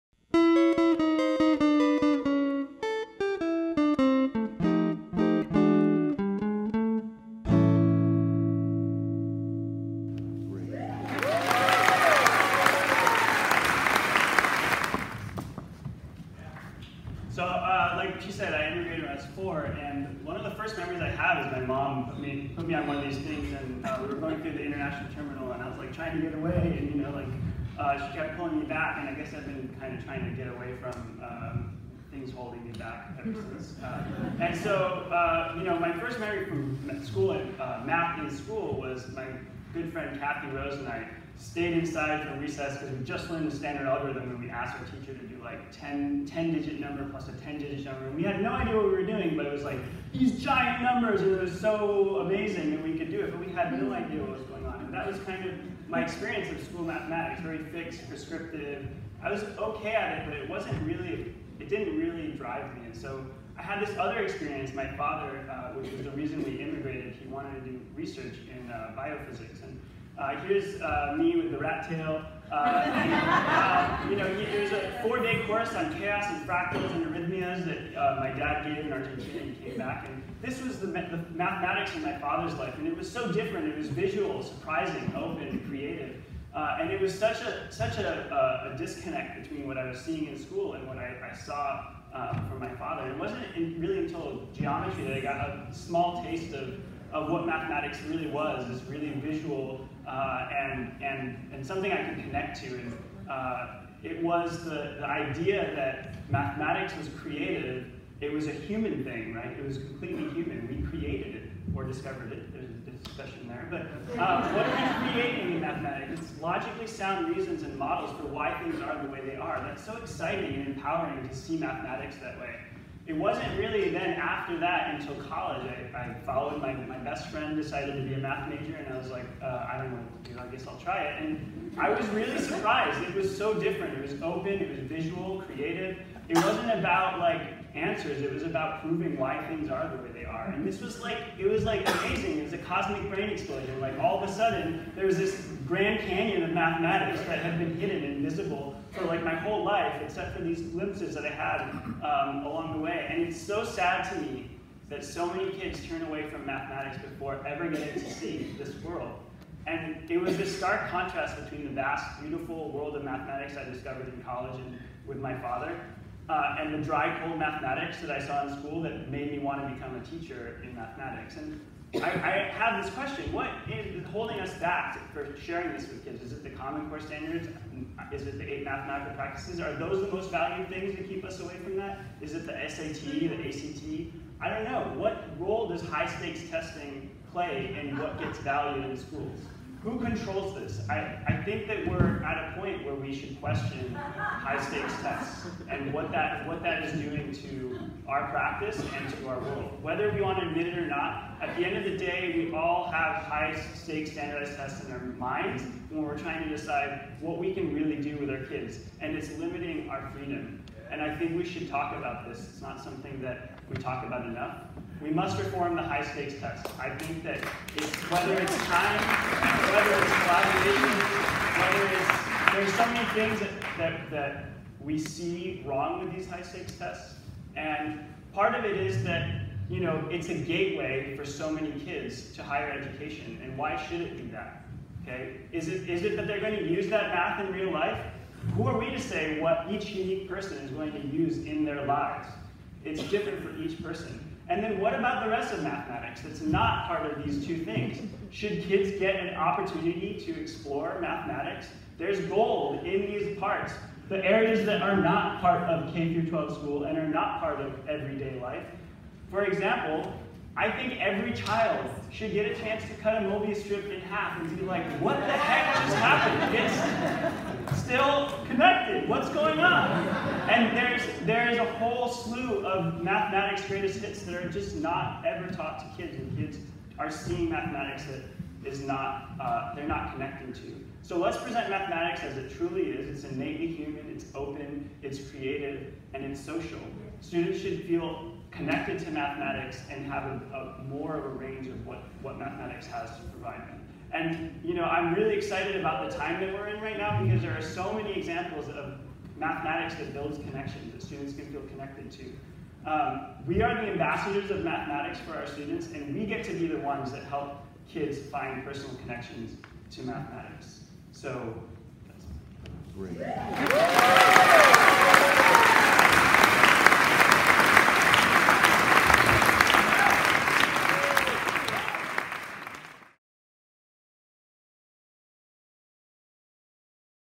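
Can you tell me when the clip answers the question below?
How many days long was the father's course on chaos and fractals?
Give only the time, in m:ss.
1:15.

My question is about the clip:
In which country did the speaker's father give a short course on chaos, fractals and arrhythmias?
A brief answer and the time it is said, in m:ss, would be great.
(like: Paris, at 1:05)
Argentina, at 1:18.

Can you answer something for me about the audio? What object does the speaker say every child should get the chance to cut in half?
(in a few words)
Mobius strip.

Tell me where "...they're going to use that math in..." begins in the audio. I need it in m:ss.
3:56.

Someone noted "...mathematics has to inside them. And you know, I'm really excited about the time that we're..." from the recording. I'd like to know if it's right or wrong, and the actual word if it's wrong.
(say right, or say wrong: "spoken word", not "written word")
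wrong: "provide", not "inside".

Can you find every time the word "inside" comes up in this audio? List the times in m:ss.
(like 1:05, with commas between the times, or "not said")
0:41.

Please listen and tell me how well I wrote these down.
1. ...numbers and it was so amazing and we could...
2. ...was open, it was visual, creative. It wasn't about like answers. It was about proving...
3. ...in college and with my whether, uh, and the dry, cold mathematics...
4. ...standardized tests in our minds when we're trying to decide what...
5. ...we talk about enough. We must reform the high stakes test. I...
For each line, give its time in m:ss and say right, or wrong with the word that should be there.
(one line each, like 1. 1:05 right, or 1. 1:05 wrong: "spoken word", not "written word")
1. 0:50 right
2. 2:14 right
3. 2:44 wrong: "father", not "whether"
4. 3:24 right
5. 3:33 right.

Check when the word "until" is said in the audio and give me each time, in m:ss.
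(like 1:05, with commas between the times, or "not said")
1:33, 2:04.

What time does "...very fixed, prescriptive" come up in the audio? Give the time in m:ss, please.
0:57.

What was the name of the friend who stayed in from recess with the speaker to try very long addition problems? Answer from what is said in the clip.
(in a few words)
Kathy Rose.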